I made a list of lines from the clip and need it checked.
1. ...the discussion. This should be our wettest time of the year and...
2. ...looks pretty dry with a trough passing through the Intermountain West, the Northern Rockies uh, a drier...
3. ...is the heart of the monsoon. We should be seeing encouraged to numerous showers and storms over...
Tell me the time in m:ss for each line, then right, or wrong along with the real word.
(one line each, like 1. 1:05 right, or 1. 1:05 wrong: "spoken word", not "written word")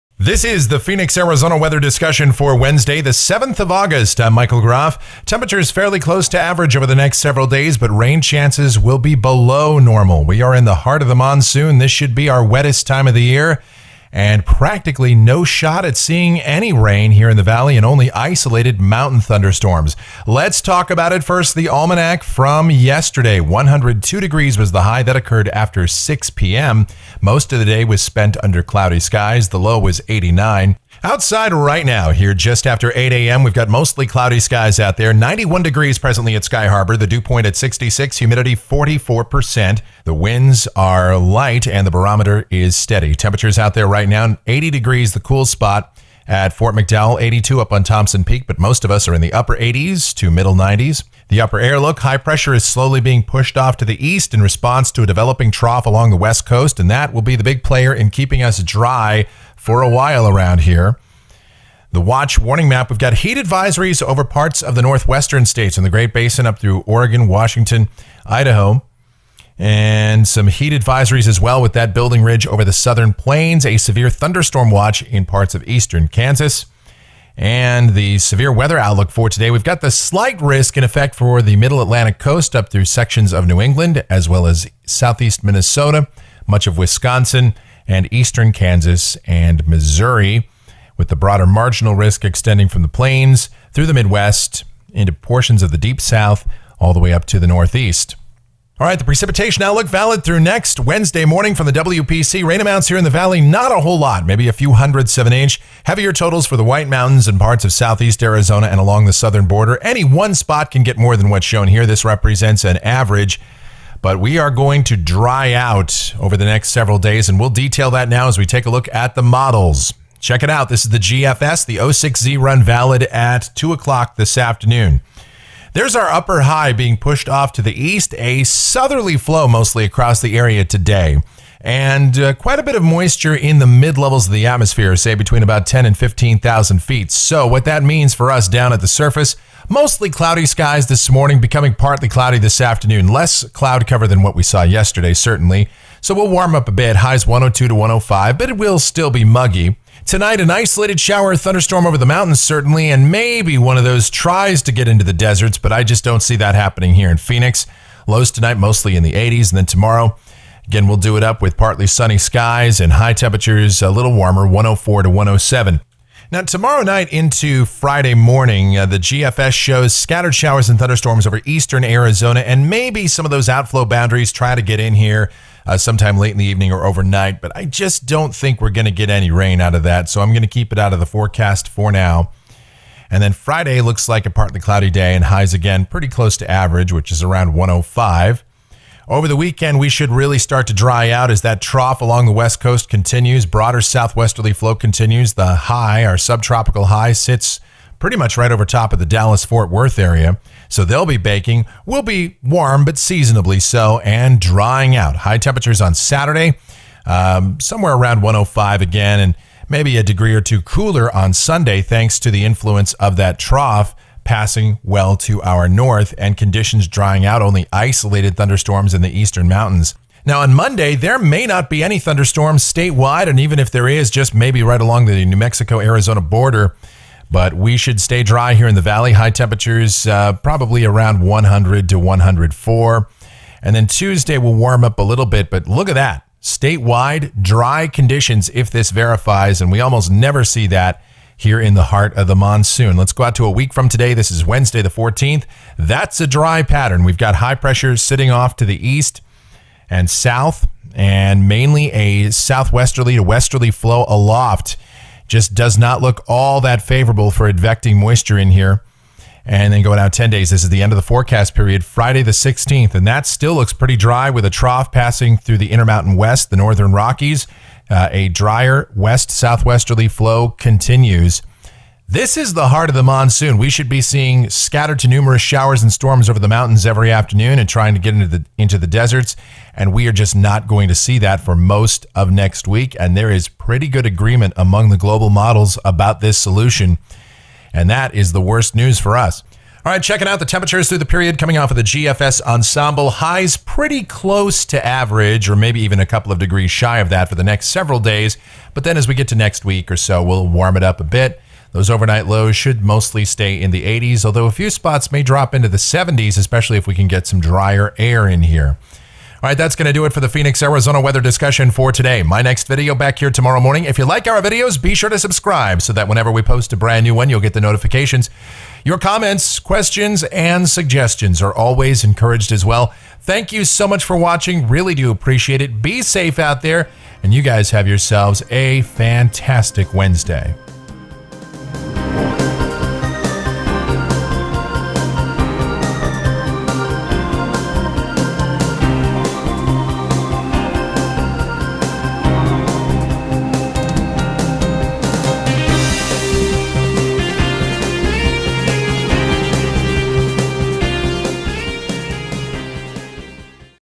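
1. 0:11 wrong: "monsoon", not "discussion"
2. 4:23 right
3. 4:32 wrong: "scattered", not "encouraged".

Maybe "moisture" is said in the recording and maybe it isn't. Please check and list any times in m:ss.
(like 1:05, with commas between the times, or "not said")
2:12, 4:17.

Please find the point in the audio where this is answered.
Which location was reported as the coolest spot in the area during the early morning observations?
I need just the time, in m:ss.
0:46.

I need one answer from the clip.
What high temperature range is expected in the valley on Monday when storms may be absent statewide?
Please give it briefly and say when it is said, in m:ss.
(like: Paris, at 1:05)
100 to 104, at 3:51.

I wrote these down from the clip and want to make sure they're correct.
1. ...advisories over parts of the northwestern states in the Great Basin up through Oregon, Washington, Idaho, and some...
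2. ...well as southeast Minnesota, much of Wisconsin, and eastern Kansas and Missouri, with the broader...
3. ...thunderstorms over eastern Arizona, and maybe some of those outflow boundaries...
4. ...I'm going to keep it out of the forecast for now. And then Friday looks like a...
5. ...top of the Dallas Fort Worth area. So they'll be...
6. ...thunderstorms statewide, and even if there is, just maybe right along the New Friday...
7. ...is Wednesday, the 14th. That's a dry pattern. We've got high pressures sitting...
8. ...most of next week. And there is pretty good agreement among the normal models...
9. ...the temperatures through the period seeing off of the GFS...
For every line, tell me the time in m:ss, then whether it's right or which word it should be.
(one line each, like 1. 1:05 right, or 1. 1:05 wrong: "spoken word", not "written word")
1. 1:03 right
2. 1:24 right
3. 2:50 right
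4. 3:00 right
5. 3:18 right
6. 3:41 wrong: "Mexico", not "Friday"
7. 4:04 right
8. 4:41 wrong: "global", not "normal"
9. 4:50 wrong: "coming", not "seeing".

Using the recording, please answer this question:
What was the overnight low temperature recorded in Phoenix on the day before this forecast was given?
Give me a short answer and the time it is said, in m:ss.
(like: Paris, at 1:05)
89, at 0:29.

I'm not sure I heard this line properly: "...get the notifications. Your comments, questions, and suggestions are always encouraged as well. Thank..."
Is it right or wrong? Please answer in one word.
right.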